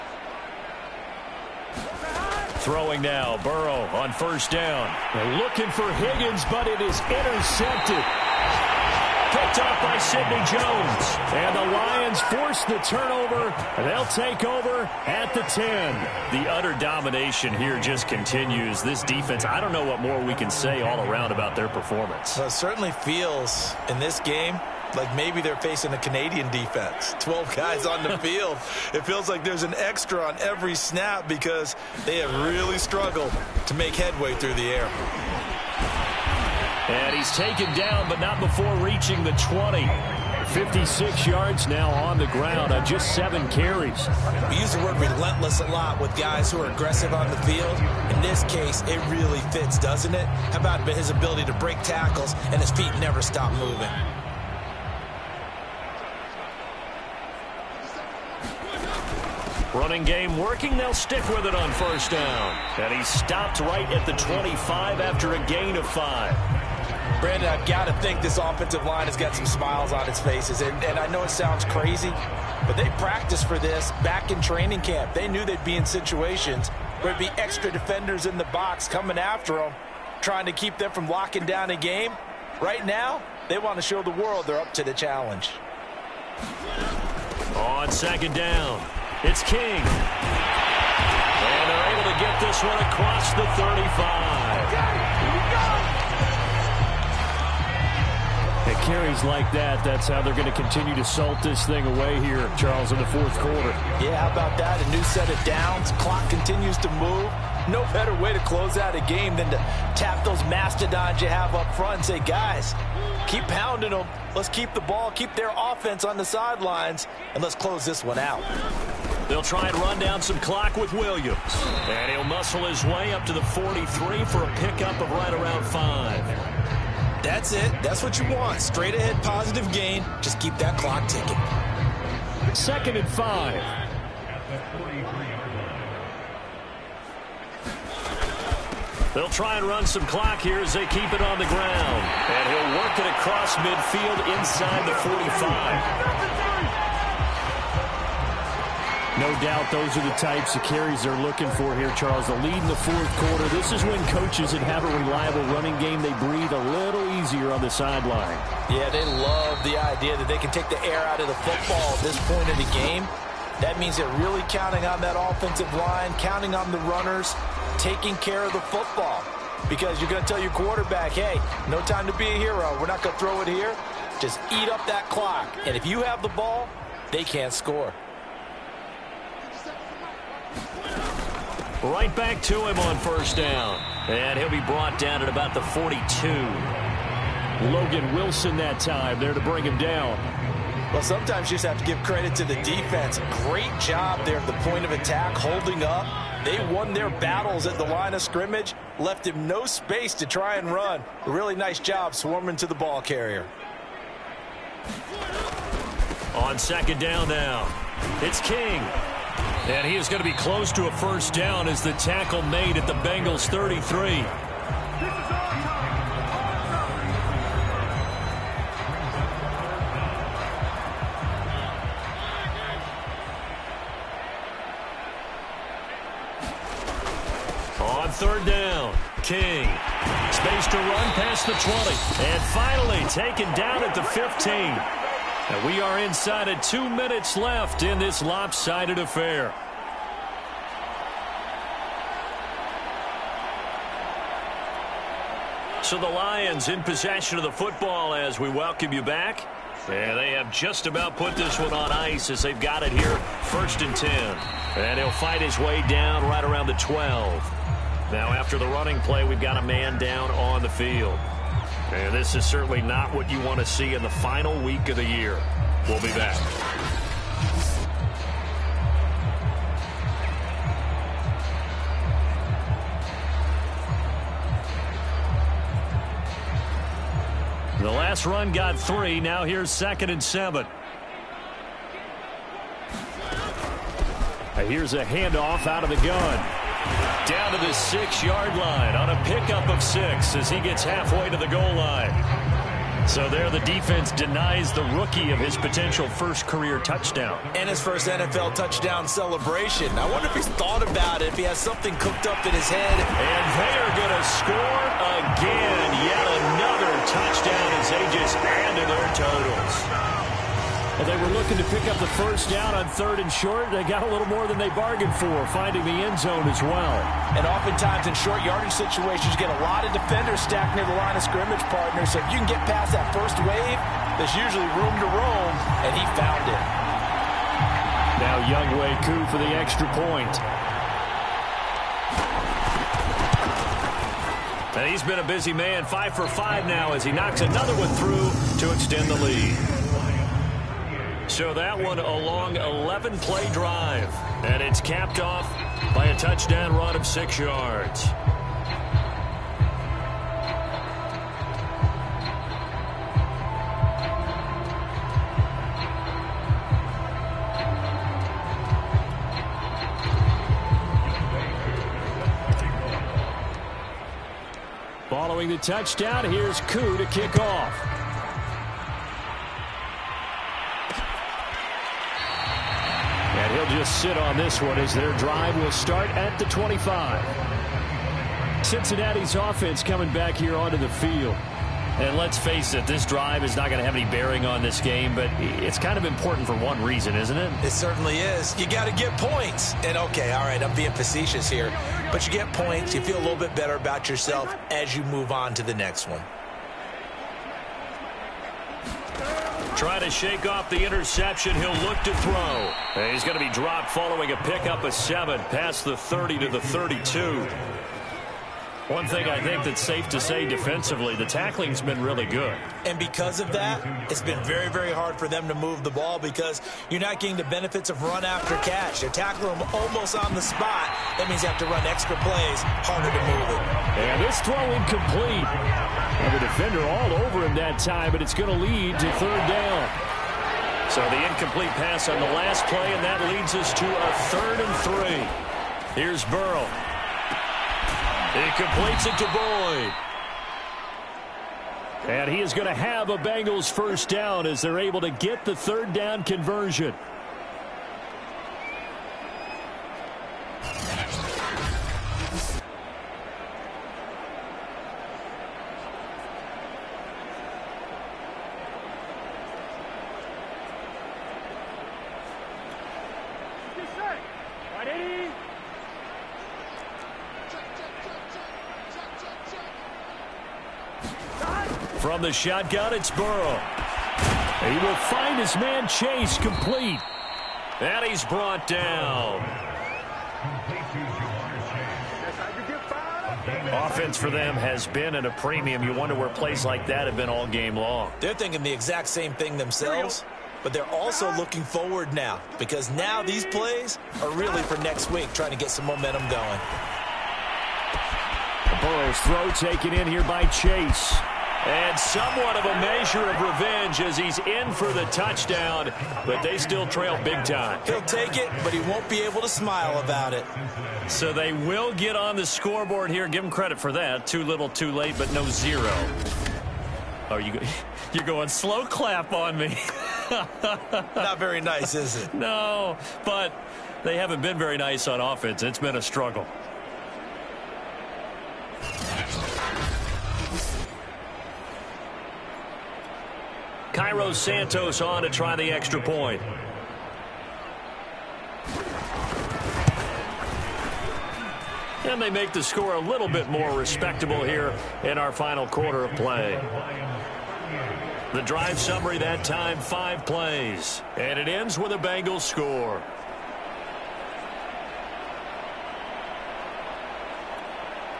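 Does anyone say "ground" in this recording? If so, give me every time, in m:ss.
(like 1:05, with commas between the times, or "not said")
0:42, 2:21.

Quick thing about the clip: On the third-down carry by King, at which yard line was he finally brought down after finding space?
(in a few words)
15.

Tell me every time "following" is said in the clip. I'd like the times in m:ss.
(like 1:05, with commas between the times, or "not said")
6:05, 6:43.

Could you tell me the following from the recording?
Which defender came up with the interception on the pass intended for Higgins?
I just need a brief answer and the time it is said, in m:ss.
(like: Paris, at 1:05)
Sidney Jones, at 0:09.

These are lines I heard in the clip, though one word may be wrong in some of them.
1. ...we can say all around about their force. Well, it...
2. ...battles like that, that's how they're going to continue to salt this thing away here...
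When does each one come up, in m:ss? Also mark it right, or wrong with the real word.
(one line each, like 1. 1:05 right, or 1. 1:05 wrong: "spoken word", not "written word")
1. 0:20 wrong: "performance", not "force"
2. 1:38 wrong: "carries", not "battles".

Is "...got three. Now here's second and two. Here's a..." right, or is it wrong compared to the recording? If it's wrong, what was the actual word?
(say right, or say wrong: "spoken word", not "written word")
wrong: "seven", not "two".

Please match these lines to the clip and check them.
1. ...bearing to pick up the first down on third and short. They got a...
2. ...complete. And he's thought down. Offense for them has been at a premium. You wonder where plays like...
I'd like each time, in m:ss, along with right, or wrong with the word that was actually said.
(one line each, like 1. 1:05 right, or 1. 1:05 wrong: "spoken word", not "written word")
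1. 5:11 wrong: "looking", not "bearing"
2. 7:56 wrong: "brought", not "thought".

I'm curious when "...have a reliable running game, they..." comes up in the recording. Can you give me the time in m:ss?
2:34.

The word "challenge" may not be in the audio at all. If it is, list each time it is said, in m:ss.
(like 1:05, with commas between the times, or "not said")
1:24.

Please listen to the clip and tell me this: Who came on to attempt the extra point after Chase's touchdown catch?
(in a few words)
Cairo Santos.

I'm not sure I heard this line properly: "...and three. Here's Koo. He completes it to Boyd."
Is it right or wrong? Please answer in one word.
wrong.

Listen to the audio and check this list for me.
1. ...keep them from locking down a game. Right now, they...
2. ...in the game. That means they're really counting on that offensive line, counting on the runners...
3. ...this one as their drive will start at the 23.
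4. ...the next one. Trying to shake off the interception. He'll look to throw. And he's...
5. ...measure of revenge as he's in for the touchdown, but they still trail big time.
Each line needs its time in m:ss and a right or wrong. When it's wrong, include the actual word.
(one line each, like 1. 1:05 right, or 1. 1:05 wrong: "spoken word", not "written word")
1. 1:20 right
2. 2:42 right
3. 6:14 wrong: "25", not "23"
4. 6:35 right
5. 8:22 right.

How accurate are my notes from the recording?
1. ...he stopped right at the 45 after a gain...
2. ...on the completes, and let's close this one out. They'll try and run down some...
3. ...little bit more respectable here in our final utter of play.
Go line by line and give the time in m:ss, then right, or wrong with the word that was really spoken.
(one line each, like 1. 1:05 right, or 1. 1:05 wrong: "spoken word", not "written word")
1. 1:02 wrong: "25", not "45"
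2. 1:56 wrong: "sidelines", not "completes"
3. 9:02 wrong: "quarter", not "utter".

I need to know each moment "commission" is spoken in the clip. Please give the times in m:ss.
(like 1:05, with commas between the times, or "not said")
not said.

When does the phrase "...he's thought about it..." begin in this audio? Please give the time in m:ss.
5:00.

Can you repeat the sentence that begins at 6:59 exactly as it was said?
You tackle them almost on the spot.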